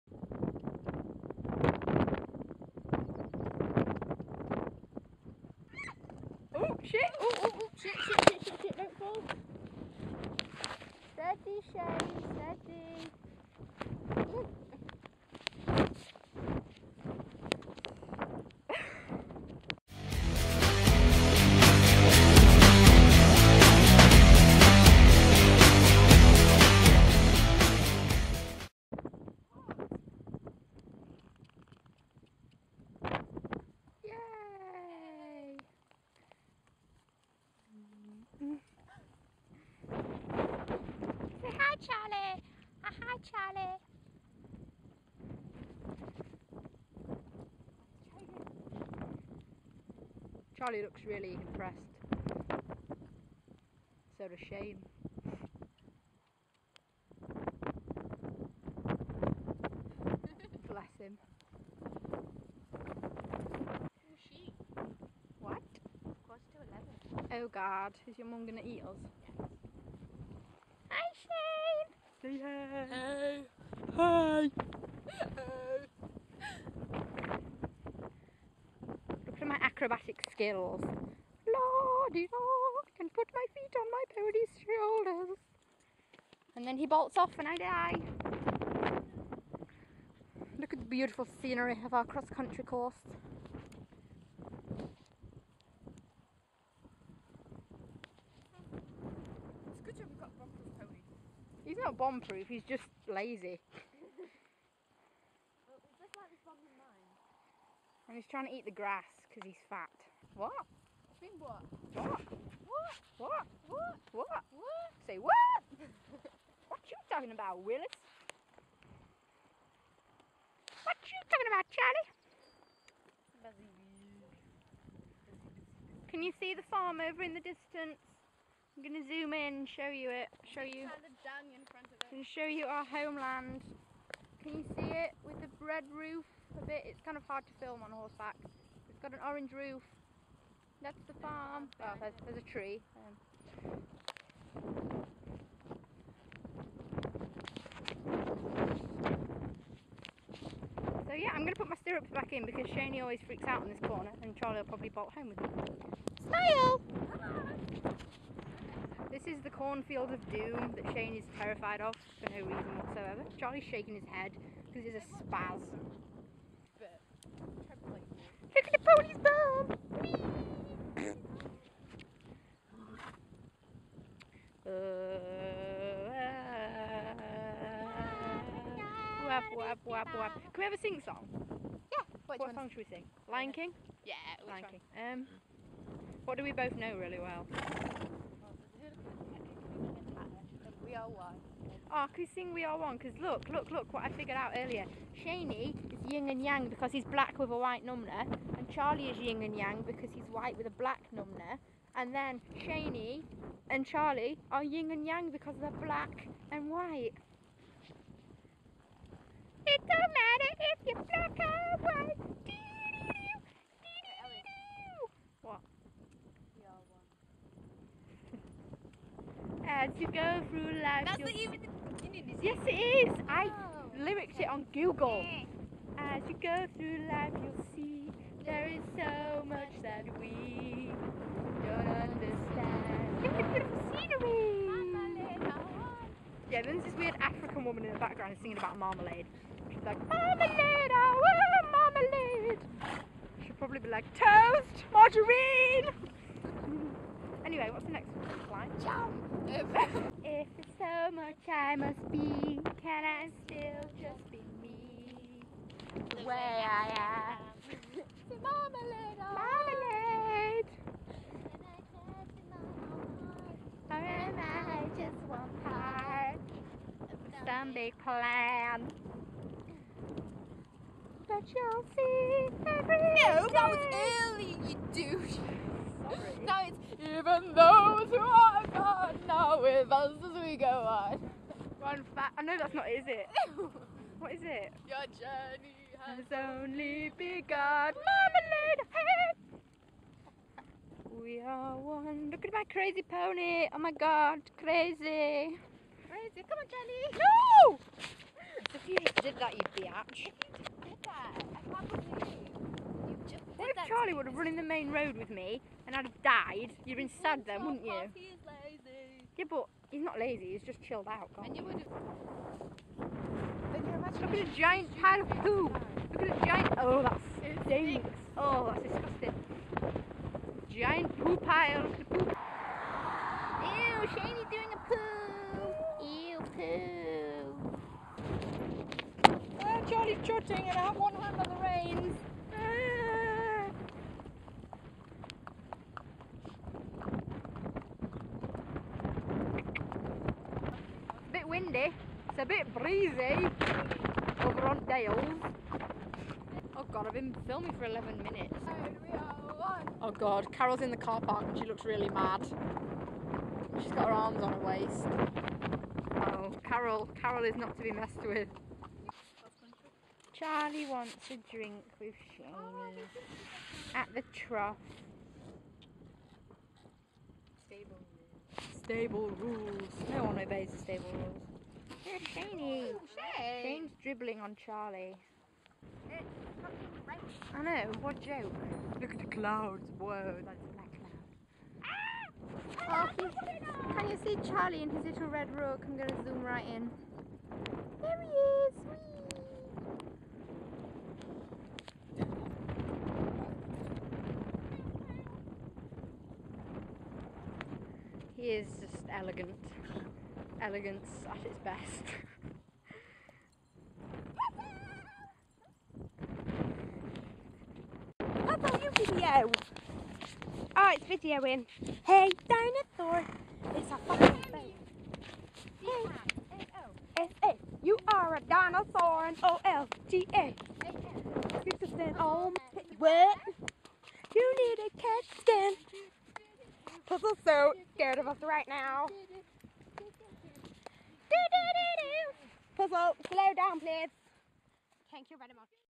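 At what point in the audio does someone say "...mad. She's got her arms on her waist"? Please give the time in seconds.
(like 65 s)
352 s.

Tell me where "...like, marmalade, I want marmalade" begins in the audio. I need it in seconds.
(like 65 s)
239 s.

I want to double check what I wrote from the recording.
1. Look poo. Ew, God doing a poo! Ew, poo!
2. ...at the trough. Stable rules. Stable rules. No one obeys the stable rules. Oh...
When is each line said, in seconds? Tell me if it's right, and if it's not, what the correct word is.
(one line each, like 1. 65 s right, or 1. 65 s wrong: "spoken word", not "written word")
1. 321 s wrong: "Shaney", not "God"
2. 363 s right.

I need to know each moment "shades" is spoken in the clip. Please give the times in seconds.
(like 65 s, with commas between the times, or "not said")
11 s.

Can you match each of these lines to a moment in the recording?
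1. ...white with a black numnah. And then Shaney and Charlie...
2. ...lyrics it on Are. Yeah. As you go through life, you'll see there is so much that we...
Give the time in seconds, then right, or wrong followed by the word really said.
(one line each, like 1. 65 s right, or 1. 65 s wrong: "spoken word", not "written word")
1. 200 s right
2. 223 s wrong: "Google", not "Are".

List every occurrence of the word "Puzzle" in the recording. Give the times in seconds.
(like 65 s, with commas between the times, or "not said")
427 s, 432 s.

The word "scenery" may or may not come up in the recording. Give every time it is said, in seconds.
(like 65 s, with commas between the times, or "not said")
91 s, 233 s.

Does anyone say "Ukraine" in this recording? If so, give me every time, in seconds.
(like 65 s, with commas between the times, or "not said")
not said.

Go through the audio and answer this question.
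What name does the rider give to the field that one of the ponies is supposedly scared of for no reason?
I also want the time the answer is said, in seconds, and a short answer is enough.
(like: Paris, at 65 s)
Cornfield of doom, at 159 s.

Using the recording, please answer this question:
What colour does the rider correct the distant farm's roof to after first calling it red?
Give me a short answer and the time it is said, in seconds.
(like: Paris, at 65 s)
Orange, at 139 s.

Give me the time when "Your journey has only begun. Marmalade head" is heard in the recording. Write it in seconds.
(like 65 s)
284 s.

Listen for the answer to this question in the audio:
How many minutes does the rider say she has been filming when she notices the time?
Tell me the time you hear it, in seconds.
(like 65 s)
347 s.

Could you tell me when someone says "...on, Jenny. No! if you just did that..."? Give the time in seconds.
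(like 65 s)
296 s.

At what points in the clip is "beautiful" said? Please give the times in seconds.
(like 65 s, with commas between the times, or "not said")
90 s, 233 s.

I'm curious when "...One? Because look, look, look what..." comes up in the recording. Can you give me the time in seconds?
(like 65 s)
192 s.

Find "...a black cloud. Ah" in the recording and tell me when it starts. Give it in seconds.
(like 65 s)
380 s.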